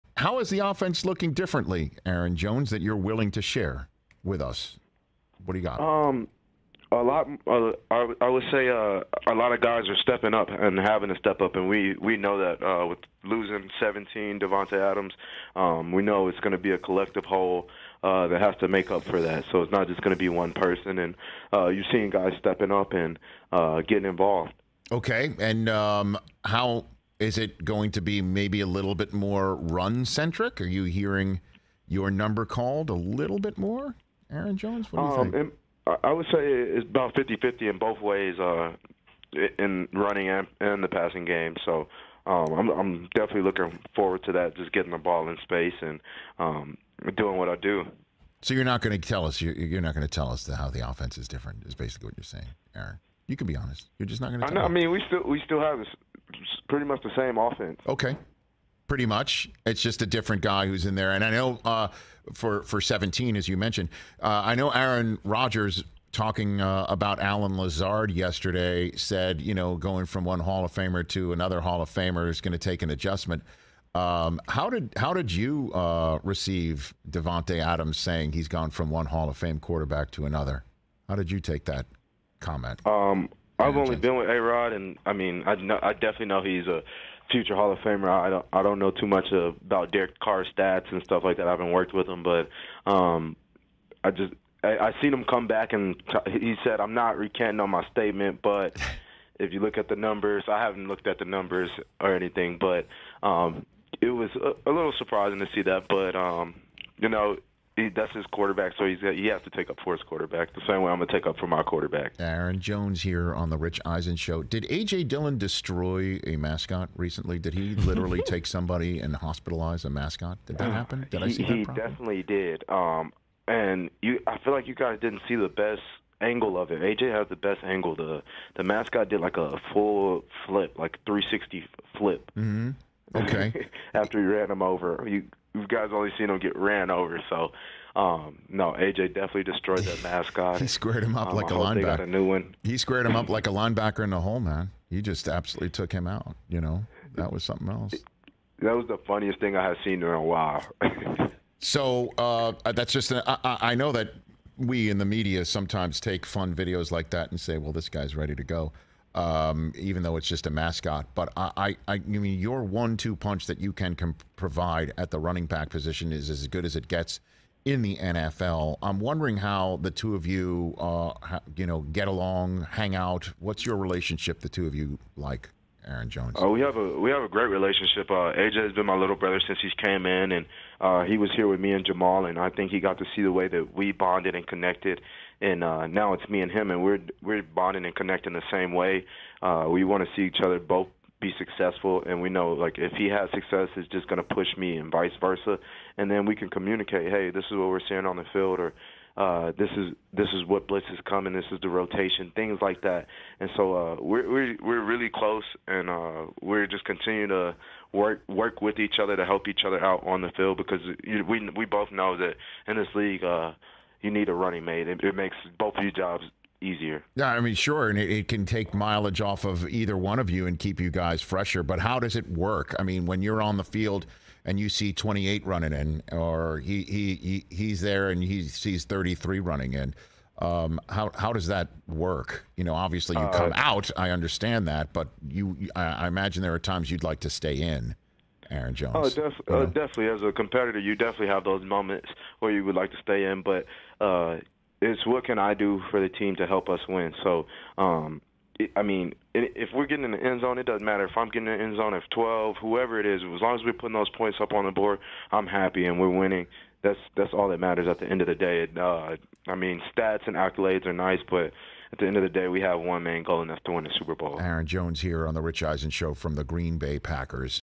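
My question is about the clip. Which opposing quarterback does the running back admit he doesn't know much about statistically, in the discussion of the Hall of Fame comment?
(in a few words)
Derek Carr.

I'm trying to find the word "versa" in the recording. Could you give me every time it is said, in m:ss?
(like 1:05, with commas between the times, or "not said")
3:15.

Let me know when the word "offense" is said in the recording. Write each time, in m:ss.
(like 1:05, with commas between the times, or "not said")
0:00, 0:50, 0:57.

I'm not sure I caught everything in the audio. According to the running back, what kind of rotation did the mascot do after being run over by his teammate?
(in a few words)
360 flip.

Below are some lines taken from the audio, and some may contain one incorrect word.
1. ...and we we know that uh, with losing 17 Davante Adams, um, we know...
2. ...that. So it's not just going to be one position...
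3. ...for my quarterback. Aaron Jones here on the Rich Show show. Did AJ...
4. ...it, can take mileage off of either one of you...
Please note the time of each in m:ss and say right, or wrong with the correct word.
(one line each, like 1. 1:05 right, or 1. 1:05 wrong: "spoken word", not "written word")
1. 0:11 right
2. 0:19 wrong: "person", not "position"
3. 1:51 wrong: "Eisen", not "Show"
4. 3:38 right.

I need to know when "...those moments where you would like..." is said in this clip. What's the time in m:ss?
4:01.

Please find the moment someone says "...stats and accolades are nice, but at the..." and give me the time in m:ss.
4:19.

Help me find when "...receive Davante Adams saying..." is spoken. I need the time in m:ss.
1:16.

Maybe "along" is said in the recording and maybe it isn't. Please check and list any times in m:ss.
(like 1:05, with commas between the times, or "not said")
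2:52.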